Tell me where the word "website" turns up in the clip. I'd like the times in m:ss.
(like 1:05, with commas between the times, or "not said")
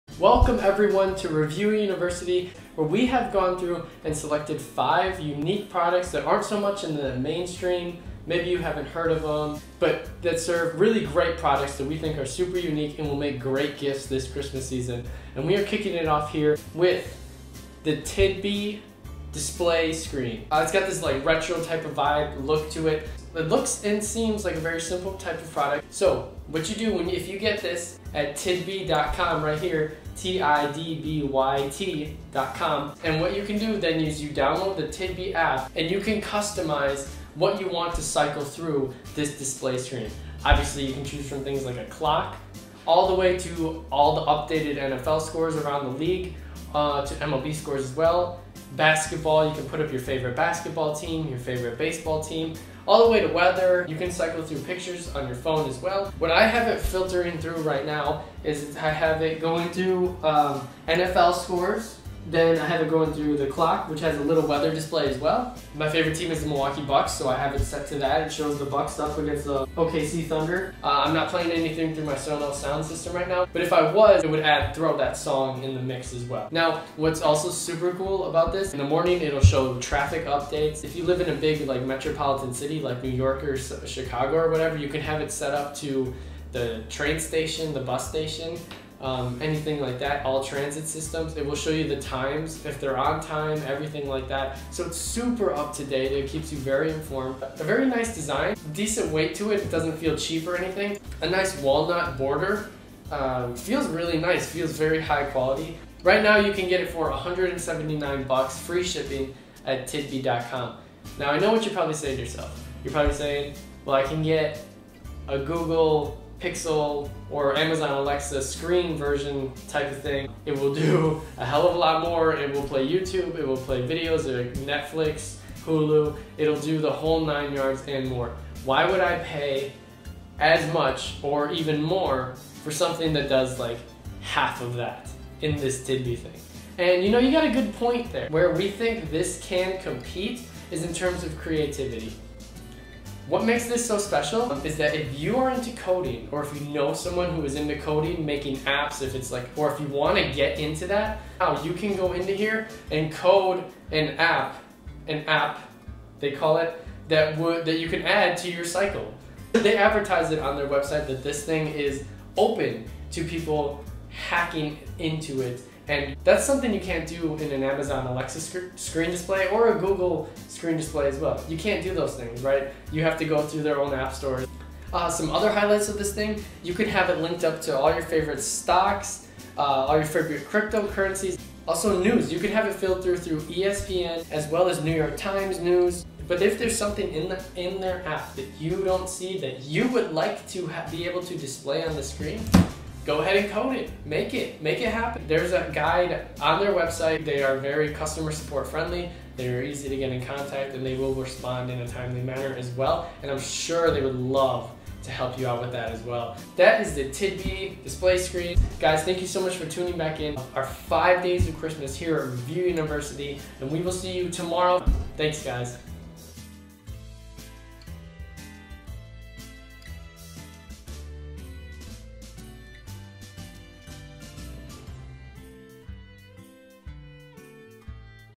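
2:40, 3:16.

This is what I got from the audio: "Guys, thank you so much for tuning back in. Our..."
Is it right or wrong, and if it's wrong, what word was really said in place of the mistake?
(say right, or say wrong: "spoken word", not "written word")
right.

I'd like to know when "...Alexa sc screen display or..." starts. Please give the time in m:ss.
2:48.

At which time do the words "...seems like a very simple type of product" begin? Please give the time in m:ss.
0:24.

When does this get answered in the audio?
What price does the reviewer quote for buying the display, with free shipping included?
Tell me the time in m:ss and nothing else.
1:47.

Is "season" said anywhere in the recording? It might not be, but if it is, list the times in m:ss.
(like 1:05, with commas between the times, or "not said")
0:14.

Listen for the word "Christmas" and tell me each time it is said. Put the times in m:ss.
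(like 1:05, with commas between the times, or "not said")
0:14, 3:31.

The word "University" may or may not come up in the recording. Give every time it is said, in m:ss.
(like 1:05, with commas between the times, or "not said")
0:01, 3:32.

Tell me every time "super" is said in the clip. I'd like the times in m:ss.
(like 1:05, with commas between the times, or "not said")
0:12, 1:17, 1:34.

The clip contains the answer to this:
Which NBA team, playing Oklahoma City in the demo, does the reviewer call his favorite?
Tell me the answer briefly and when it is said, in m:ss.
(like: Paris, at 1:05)
Milwaukee Bucks, at 1:06.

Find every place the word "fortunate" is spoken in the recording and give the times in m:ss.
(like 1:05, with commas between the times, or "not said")
not said.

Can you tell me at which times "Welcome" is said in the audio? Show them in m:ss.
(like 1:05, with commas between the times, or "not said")
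0:00.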